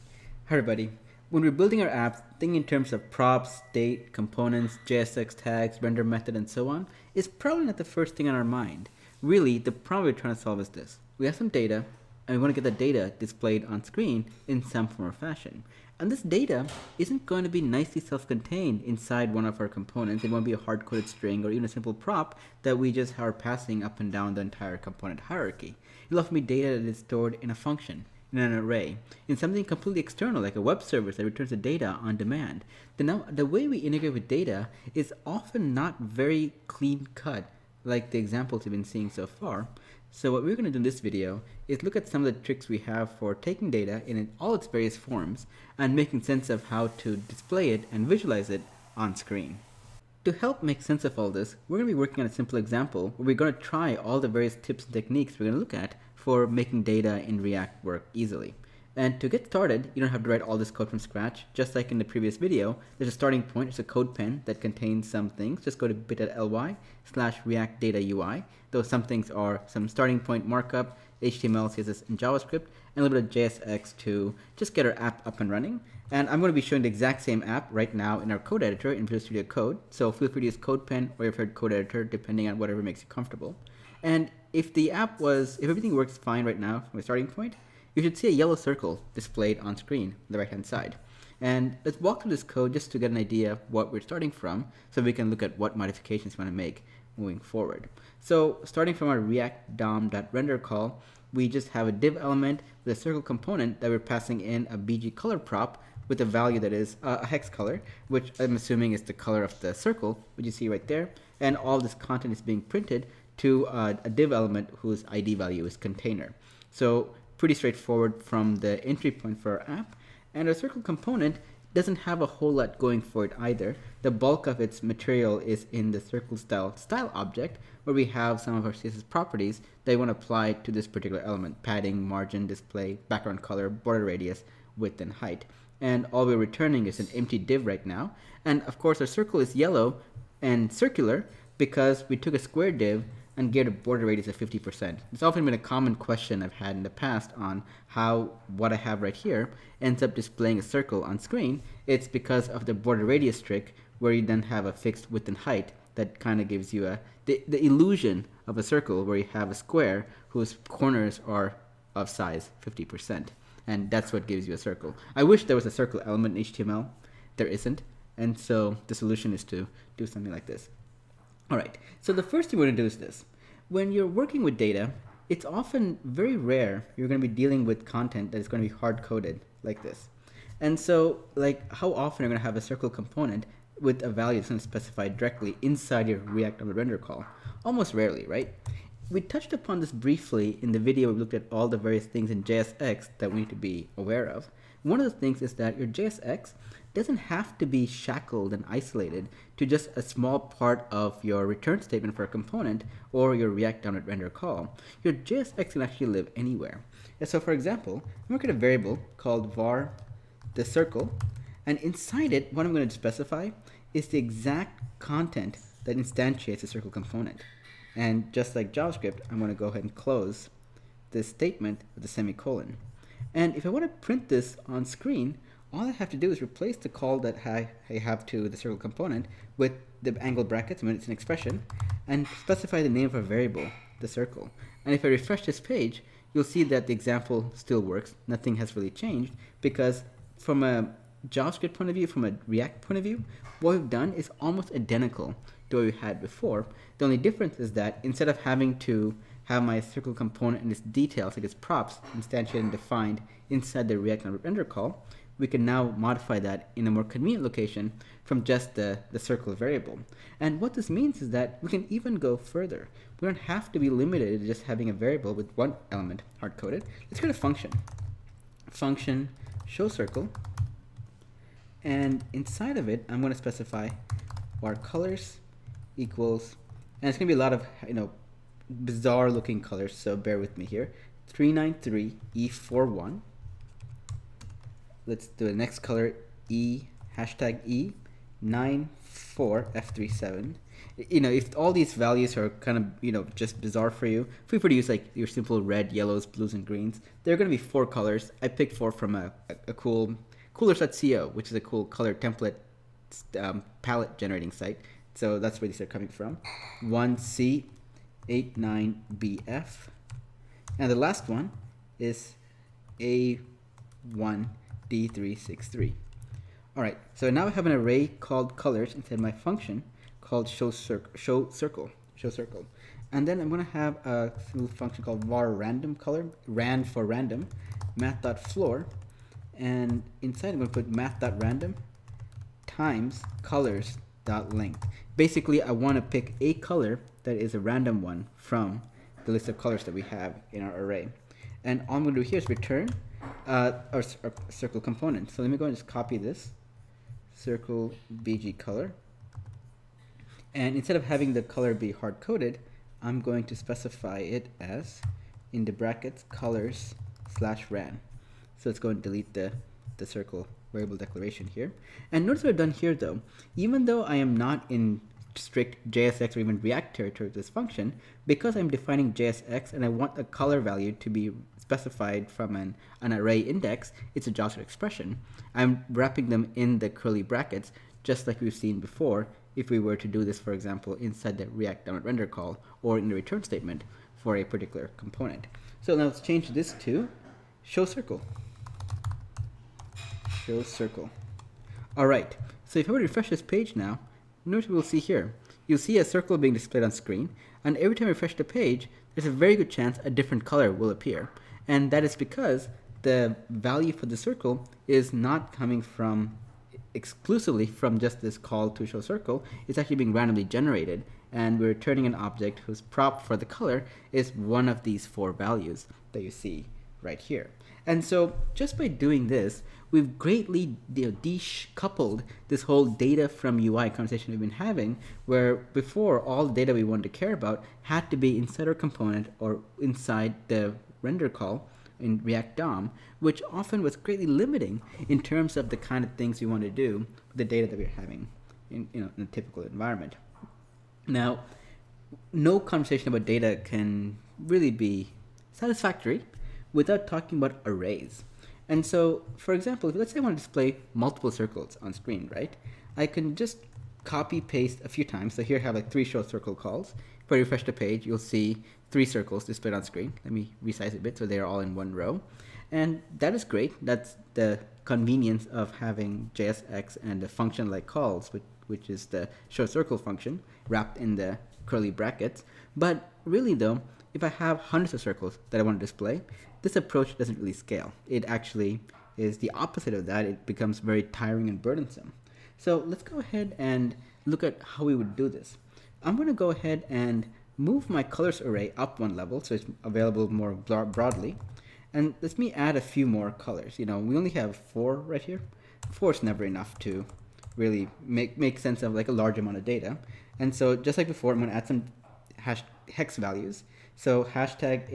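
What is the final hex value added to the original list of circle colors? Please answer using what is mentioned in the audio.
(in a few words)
A1D363.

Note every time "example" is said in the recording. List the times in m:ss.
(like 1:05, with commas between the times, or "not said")
0:38, 0:52, 3:27, 3:56, 6:20, 7:29.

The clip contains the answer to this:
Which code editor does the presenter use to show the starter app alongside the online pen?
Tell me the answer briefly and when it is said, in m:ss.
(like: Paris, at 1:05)
Visual Studio Code, at 1:19.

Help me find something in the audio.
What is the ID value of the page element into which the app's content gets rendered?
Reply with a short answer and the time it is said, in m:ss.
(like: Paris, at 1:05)
container, at 1:55.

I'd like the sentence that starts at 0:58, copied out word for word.
And to get started, you don't have to write all this code from scratch.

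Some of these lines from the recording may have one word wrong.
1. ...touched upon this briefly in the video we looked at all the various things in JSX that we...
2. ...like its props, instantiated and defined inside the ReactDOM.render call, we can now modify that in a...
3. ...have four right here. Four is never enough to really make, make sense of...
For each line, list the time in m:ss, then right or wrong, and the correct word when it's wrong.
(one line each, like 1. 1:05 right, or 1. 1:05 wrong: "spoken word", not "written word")
1. 3:09 right
2. 4:11 right
3. 8:14 right.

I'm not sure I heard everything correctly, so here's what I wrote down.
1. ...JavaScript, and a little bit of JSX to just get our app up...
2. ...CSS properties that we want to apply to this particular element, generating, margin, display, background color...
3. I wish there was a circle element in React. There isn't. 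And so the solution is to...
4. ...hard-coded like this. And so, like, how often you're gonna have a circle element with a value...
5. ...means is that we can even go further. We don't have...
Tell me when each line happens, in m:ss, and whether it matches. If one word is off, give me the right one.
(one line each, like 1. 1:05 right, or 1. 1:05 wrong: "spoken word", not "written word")
1. 1:12 right
2. 2:08 wrong: "padding", not "generating"
3. 2:45 wrong: "HTML", not "React"
4. 2:58 wrong: "component", not "element"
5. 4:20 right.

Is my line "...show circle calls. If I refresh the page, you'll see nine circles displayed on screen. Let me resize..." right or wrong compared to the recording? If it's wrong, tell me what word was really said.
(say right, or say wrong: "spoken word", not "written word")
wrong: "three", not "nine".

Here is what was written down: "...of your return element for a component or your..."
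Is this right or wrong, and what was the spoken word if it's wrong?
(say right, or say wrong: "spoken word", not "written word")
wrong: "statement", not "element".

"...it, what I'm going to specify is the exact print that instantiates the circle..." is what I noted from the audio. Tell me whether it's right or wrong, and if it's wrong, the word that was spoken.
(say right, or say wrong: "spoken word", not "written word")
wrong: "content", not "print".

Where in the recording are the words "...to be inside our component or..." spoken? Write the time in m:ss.
7:08.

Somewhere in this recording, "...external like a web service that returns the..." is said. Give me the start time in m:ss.
0:29.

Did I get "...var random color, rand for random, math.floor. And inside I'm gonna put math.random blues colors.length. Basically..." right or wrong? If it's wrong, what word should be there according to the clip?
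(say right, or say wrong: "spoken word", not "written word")
wrong: "times", not "blues".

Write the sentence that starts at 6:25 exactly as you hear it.
So now let's change this to show circle.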